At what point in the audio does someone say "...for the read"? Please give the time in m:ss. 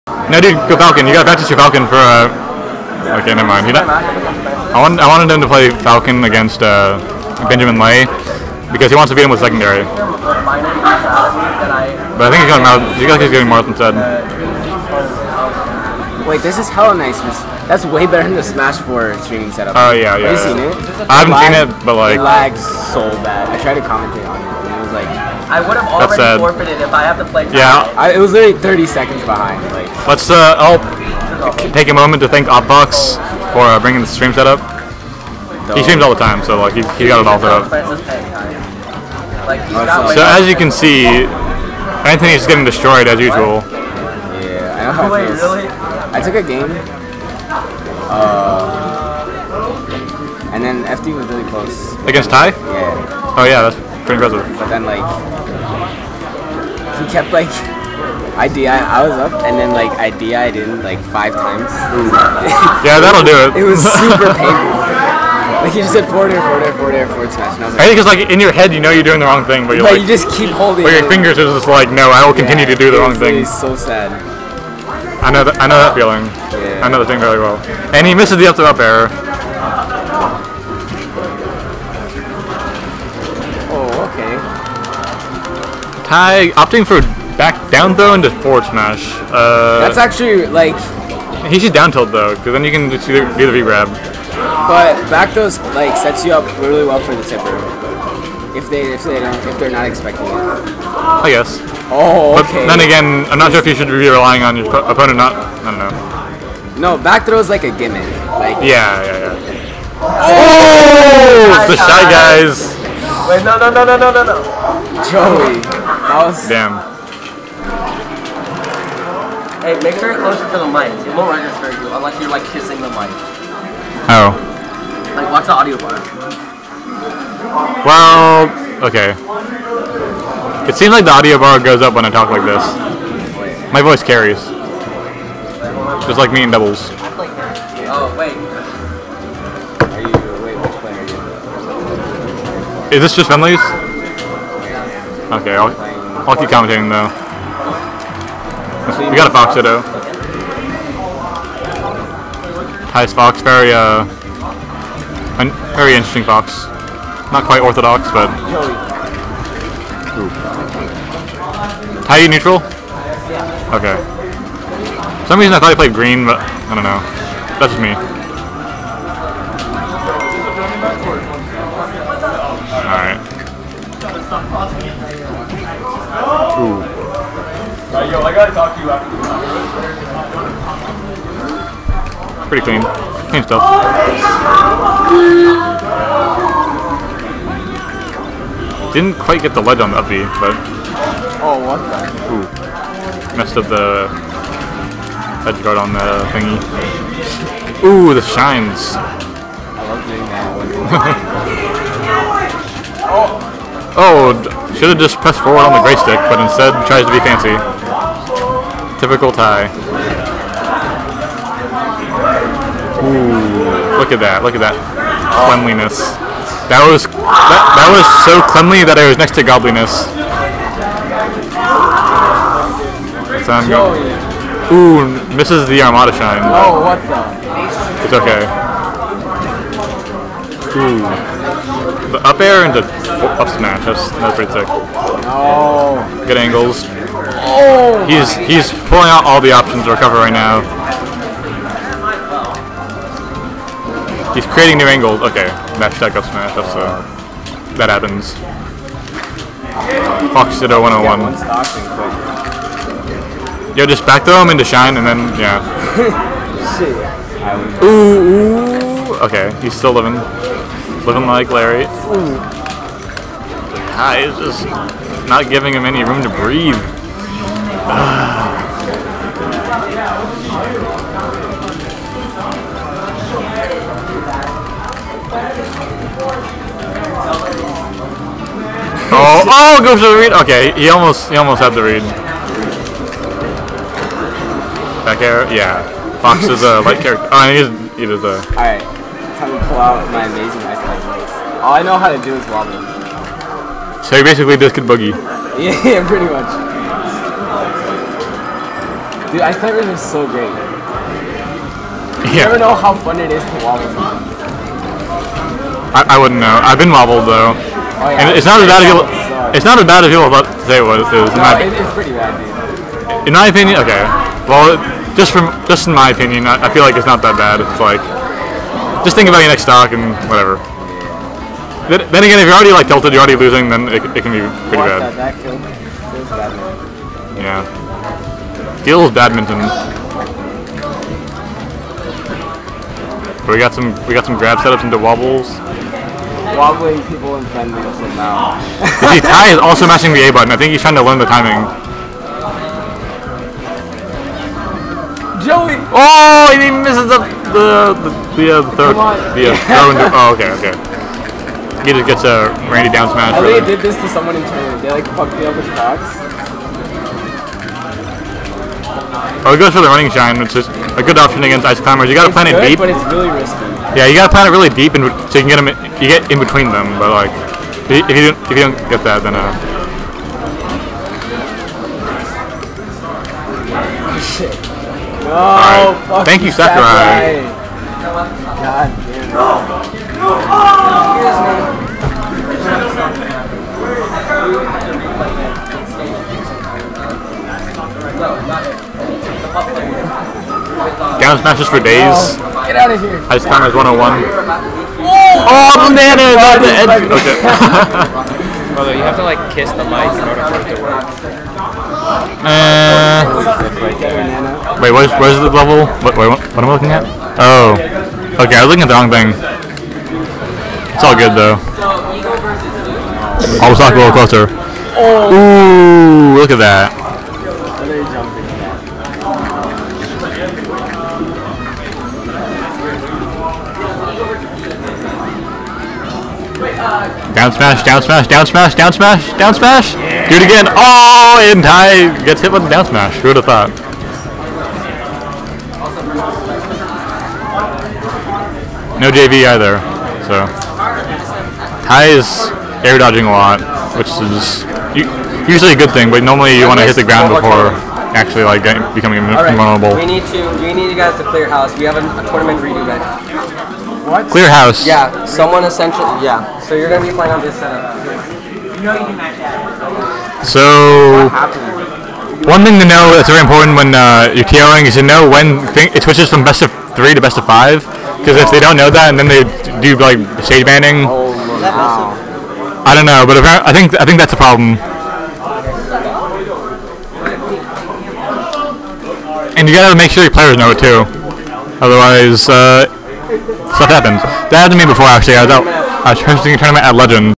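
4:39.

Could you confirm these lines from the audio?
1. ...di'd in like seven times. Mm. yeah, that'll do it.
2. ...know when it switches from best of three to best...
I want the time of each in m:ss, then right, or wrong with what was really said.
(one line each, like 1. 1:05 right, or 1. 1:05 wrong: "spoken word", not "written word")
1. 1:00 wrong: "five", not "seven"
2. 7:45 right.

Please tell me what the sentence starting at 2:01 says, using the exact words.
It won't register you unless you're like kissing the mic.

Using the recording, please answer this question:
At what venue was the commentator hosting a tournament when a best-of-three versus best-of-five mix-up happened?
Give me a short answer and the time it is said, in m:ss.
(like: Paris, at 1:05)
Legends, at 8:06.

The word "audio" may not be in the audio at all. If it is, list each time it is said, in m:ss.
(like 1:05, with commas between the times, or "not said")
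2:05, 2:11.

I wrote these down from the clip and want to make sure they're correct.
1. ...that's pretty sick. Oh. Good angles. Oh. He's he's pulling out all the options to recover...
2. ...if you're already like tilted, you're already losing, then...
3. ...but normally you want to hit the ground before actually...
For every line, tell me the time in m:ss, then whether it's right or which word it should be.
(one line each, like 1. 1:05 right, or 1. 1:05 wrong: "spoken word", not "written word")
1. 3:54 right
2. 5:22 right
3. 7:26 right.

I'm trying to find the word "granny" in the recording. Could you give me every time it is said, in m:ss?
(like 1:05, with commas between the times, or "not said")
not said.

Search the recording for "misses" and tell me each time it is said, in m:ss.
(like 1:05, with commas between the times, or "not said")
1:18, 3:45, 5:46.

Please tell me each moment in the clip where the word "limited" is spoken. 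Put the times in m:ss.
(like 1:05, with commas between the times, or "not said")
not said.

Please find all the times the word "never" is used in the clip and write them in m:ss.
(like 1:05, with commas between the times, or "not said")
0:03, 5:02.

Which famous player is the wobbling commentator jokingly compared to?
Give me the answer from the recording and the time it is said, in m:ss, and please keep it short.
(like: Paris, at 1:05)
discus boogie, at 4:54.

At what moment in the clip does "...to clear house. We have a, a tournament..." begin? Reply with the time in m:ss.
7:31.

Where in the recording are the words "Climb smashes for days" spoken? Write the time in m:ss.
6:31.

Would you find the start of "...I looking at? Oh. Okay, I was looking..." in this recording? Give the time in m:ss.
6:46.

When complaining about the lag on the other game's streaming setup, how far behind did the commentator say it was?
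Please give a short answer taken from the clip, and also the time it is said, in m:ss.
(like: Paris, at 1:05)
30 seconds, at 0:28.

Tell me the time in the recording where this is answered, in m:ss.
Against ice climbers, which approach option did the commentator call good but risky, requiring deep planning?
5:59.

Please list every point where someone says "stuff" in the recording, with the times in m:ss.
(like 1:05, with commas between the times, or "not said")
3:03, 8:03.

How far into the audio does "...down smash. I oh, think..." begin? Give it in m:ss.
5:52.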